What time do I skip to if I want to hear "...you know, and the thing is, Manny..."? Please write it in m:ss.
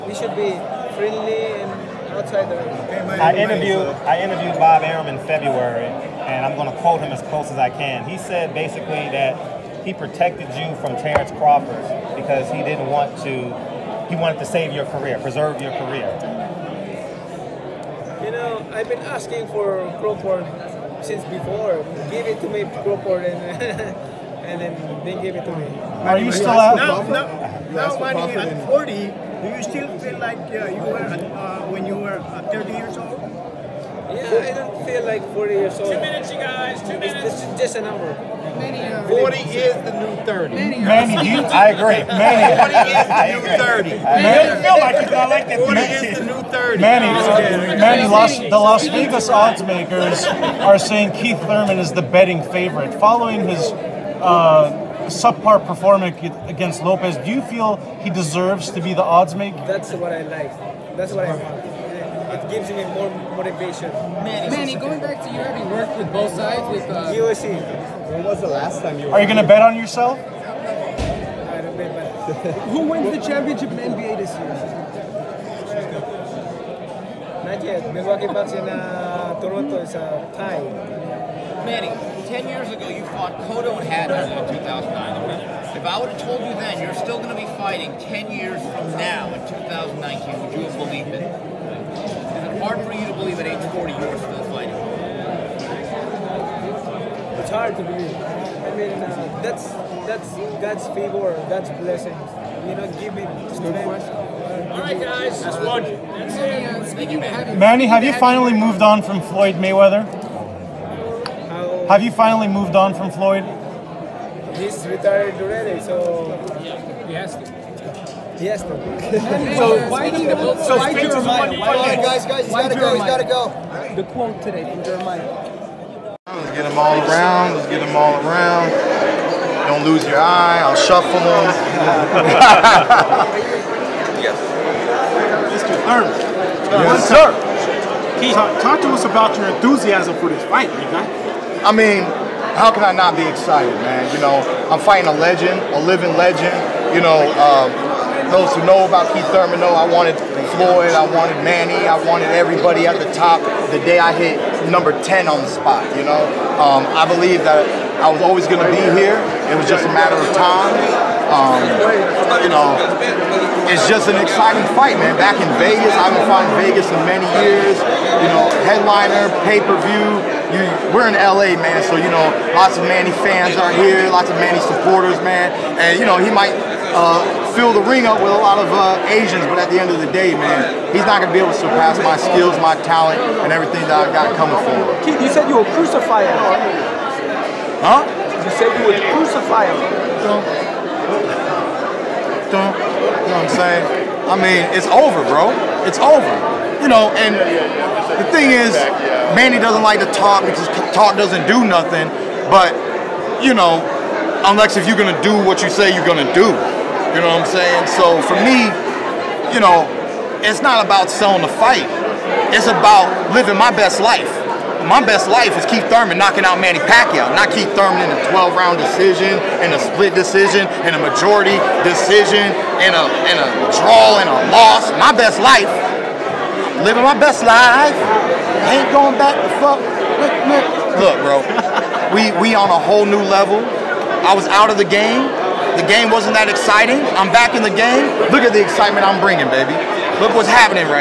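3:16.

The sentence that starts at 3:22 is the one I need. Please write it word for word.
But you know, unless if you're gonna do what you say you're gonna do, you know what I'm saying?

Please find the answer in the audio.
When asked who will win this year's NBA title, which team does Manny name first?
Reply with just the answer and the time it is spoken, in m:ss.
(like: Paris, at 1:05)
Milwaukee Bucks, at 1:17.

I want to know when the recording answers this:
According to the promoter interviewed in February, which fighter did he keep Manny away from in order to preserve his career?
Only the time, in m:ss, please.
0:11.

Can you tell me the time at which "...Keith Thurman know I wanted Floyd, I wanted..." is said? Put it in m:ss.
2:29.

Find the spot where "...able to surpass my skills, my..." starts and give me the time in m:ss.
3:01.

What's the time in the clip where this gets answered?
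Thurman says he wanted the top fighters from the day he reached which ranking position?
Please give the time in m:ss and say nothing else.
2:34.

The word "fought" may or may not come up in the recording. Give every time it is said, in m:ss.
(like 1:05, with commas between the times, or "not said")
1:23, 2:46.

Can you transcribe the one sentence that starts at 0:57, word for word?
Do you feel he deserves to be the odds maker?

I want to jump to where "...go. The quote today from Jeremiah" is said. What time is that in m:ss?
2:03.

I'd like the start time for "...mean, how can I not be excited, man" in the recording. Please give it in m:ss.
2:21.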